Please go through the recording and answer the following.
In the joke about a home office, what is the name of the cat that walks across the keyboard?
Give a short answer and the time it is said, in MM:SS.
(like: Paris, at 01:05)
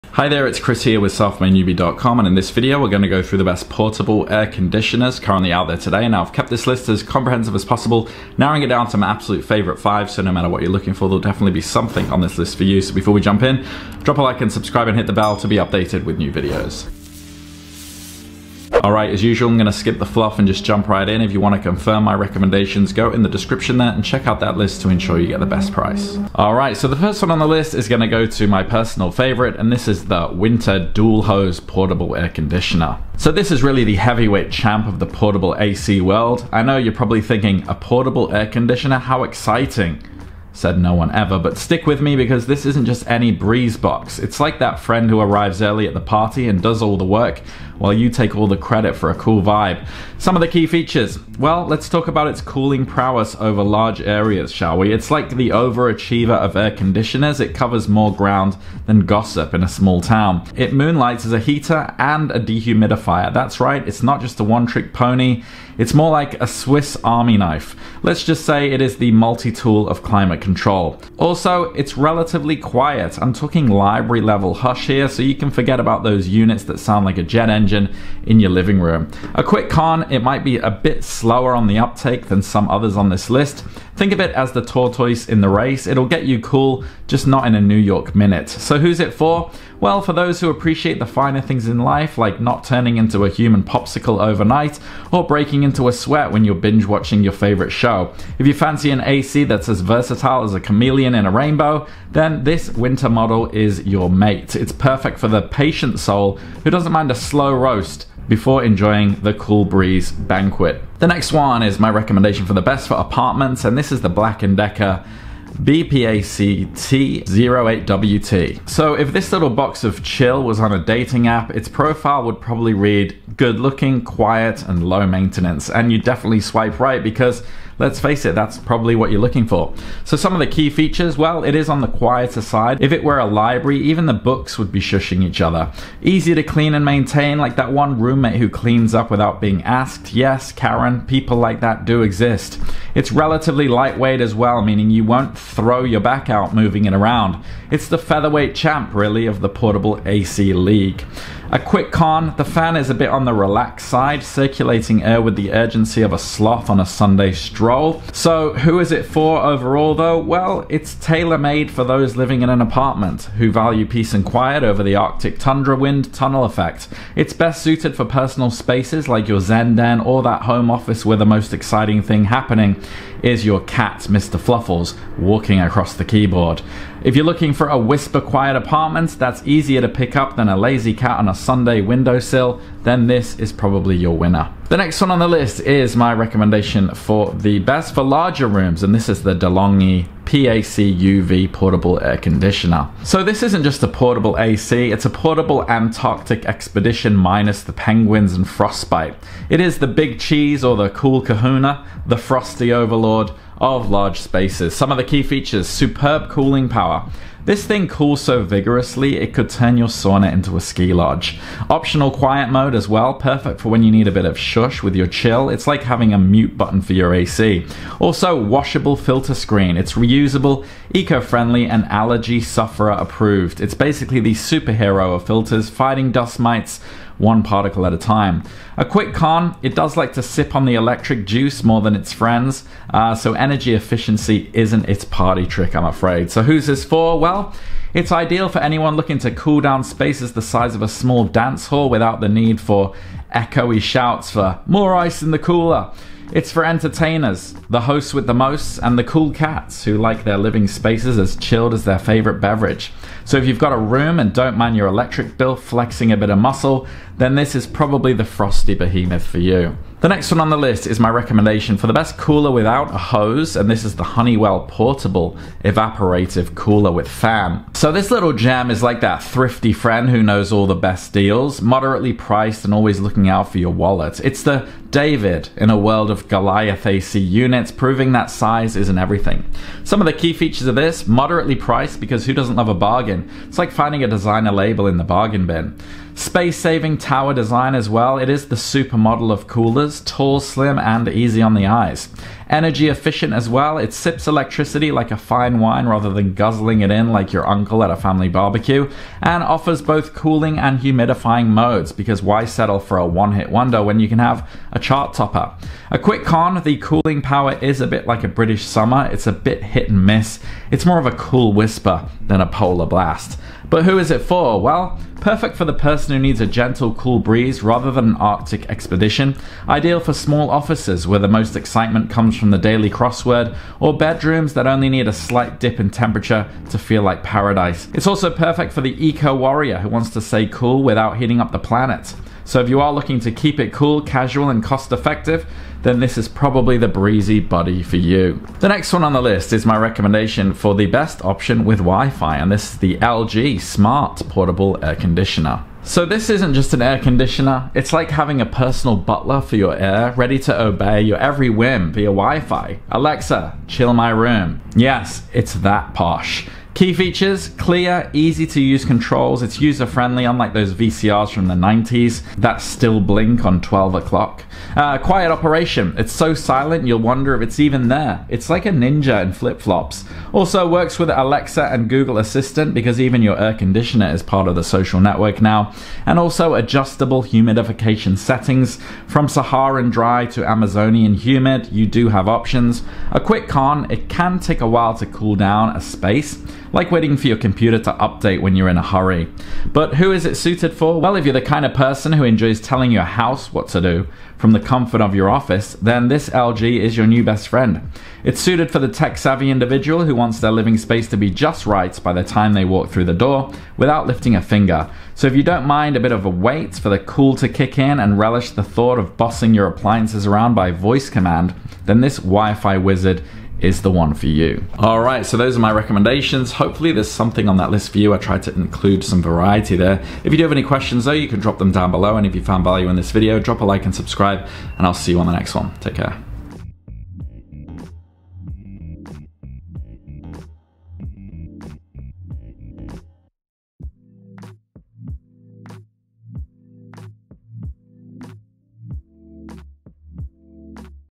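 Mr. Fluffles, at 02:54.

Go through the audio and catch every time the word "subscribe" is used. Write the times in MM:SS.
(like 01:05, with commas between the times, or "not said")
00:14, 07:03.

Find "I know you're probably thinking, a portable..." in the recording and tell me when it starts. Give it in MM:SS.
00:36.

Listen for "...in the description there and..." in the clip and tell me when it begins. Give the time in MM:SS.
00:23.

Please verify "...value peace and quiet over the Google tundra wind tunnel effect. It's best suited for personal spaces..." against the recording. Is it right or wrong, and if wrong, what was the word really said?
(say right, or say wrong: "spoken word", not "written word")
wrong: "Arctic", not "Google".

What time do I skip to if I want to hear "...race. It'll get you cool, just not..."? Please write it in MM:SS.
01:25.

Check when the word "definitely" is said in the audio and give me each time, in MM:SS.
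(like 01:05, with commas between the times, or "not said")
00:11, 02:05.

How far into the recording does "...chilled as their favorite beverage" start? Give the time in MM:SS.
04:11.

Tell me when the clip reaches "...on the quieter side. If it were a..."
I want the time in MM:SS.
02:11.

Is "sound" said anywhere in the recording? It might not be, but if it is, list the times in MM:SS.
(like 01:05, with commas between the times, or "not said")
01:16.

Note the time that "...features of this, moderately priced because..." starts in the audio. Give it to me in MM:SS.
04:40.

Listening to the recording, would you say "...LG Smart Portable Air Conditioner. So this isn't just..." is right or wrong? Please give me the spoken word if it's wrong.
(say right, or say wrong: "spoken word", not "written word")
right.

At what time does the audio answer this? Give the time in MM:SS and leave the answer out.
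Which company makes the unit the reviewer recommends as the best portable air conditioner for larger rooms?
03:09.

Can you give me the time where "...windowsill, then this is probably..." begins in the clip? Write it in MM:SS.
03:01.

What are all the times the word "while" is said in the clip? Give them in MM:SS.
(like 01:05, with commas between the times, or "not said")
00:47, 06:24.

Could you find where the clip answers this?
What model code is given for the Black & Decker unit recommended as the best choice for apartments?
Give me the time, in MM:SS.
01:55.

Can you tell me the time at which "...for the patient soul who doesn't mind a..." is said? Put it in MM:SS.
01:45.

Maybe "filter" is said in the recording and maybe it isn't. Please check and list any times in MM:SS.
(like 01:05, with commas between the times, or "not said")
03:38, 03:45.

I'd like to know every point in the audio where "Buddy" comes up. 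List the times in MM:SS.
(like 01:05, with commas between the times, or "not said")
05:37.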